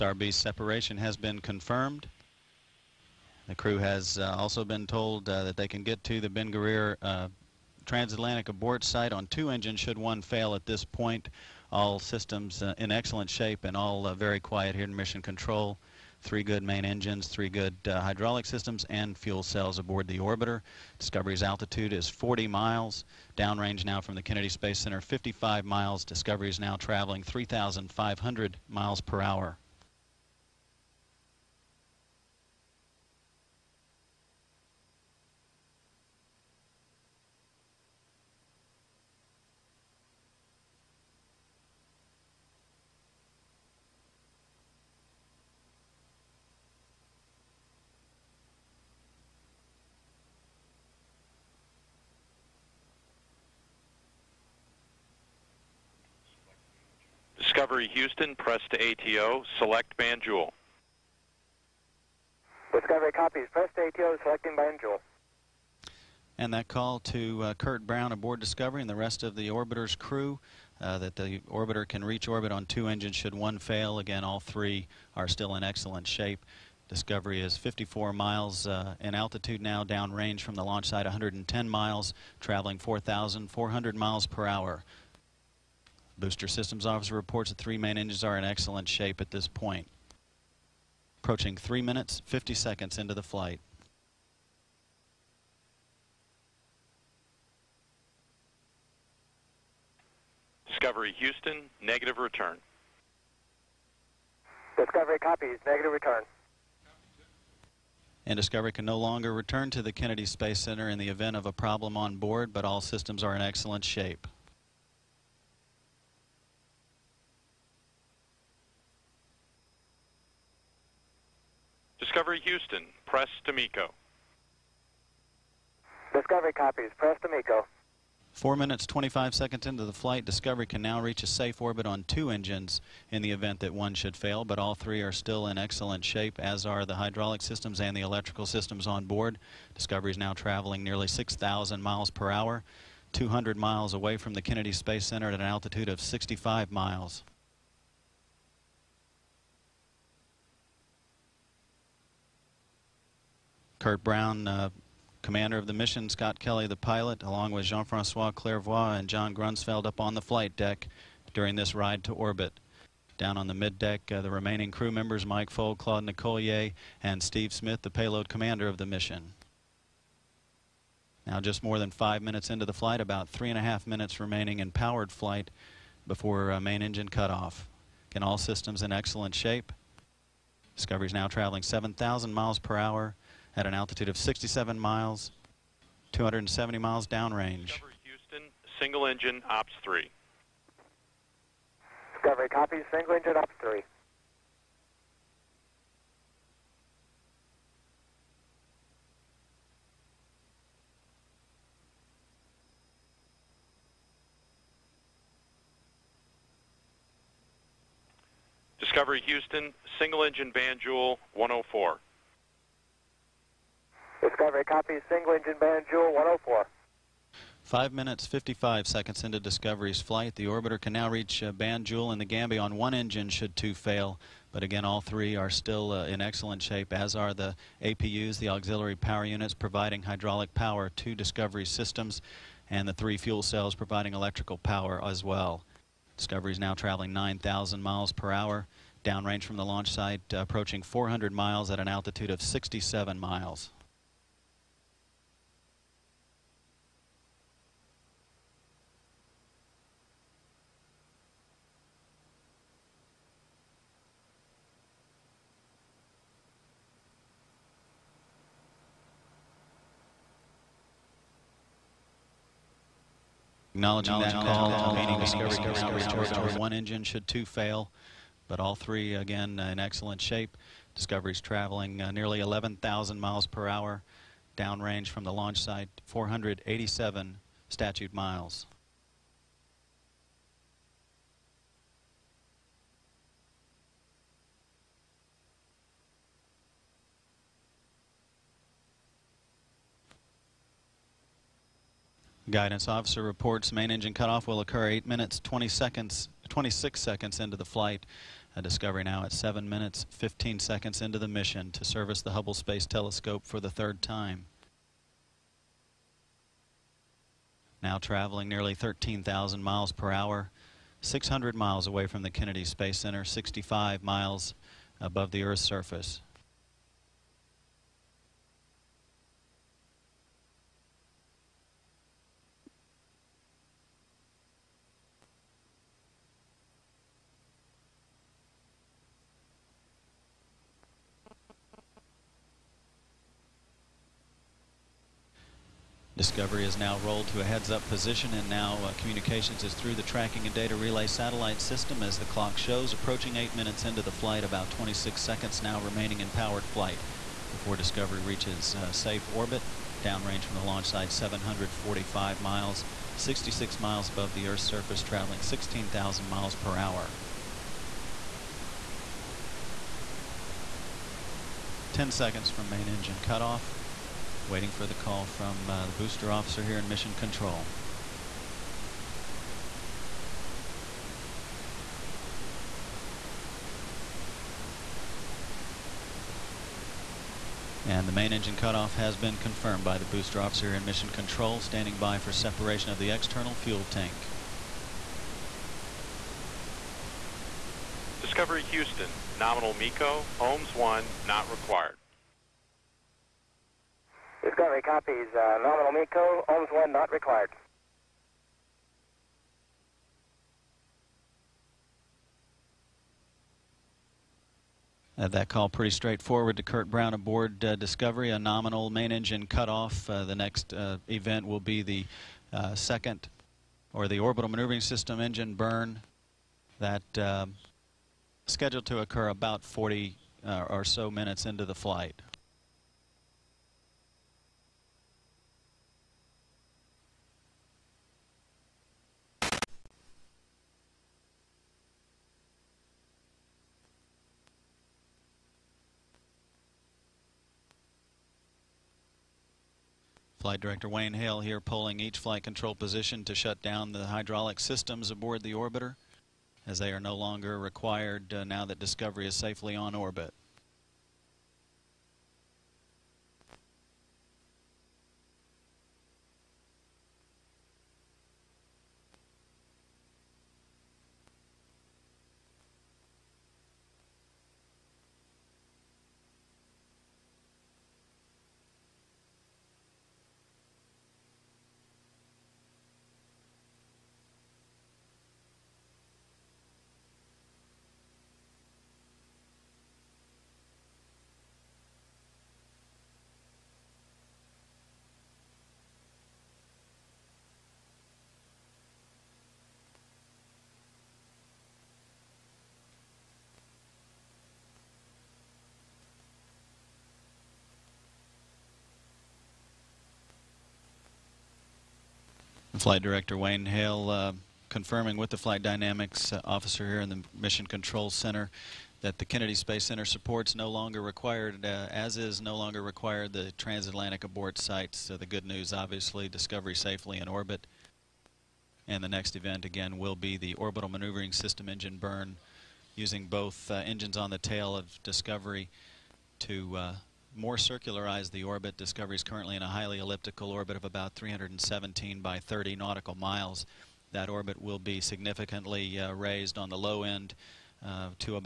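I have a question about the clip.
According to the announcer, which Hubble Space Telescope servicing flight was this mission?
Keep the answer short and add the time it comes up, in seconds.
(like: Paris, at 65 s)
third, at 303 s.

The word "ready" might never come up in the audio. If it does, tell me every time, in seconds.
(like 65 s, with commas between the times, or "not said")
not said.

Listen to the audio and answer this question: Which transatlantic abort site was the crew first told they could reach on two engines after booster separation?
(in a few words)
Ben Guerir.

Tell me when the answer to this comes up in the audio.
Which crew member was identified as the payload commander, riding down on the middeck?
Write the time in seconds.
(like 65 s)
167 s.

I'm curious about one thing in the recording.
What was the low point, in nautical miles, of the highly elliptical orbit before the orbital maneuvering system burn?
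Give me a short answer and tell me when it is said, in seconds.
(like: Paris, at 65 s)
30, at 532 s.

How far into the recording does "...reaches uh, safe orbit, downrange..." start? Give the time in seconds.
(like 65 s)
348 s.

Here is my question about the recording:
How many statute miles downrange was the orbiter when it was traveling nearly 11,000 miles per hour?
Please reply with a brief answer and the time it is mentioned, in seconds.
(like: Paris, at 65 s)
487, at 276 s.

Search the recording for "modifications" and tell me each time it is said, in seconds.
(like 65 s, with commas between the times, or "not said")
not said.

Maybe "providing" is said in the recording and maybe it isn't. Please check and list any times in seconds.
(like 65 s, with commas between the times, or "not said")
229 s, 233 s.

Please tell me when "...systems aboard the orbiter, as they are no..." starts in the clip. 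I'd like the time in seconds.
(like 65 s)
444 s.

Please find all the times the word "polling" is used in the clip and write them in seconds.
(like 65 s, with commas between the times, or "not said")
441 s.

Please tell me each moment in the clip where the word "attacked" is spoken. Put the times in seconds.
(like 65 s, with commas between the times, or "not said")
not said.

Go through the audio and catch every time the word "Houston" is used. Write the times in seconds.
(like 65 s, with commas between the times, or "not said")
57 s, 101 s, 122 s, 188 s, 209 s, 388 s.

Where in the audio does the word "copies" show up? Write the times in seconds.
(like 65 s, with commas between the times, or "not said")
63 s, 105 s, 126 s, 192 s, 394 s.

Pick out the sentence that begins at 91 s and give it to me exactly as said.
Approaching 3 minutes, 50 seconds into the flight.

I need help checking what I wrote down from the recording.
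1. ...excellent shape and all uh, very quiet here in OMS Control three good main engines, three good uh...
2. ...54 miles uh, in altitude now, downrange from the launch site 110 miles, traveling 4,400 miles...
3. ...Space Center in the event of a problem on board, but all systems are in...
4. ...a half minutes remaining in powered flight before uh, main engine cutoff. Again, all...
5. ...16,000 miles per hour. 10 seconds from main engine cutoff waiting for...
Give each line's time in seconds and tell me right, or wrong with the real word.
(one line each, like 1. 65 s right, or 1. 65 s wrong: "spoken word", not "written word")
1. 12 s wrong: "Mission", not "OMS"
2. 77 s right
3. 110 s right
4. 173 s right
5. 355 s right.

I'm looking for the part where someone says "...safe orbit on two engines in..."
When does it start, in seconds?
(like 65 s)
131 s.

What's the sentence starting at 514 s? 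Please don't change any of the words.
So the good news, obviously, discovery safely in orbit.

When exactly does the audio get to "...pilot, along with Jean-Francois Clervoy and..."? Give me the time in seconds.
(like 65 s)
156 s.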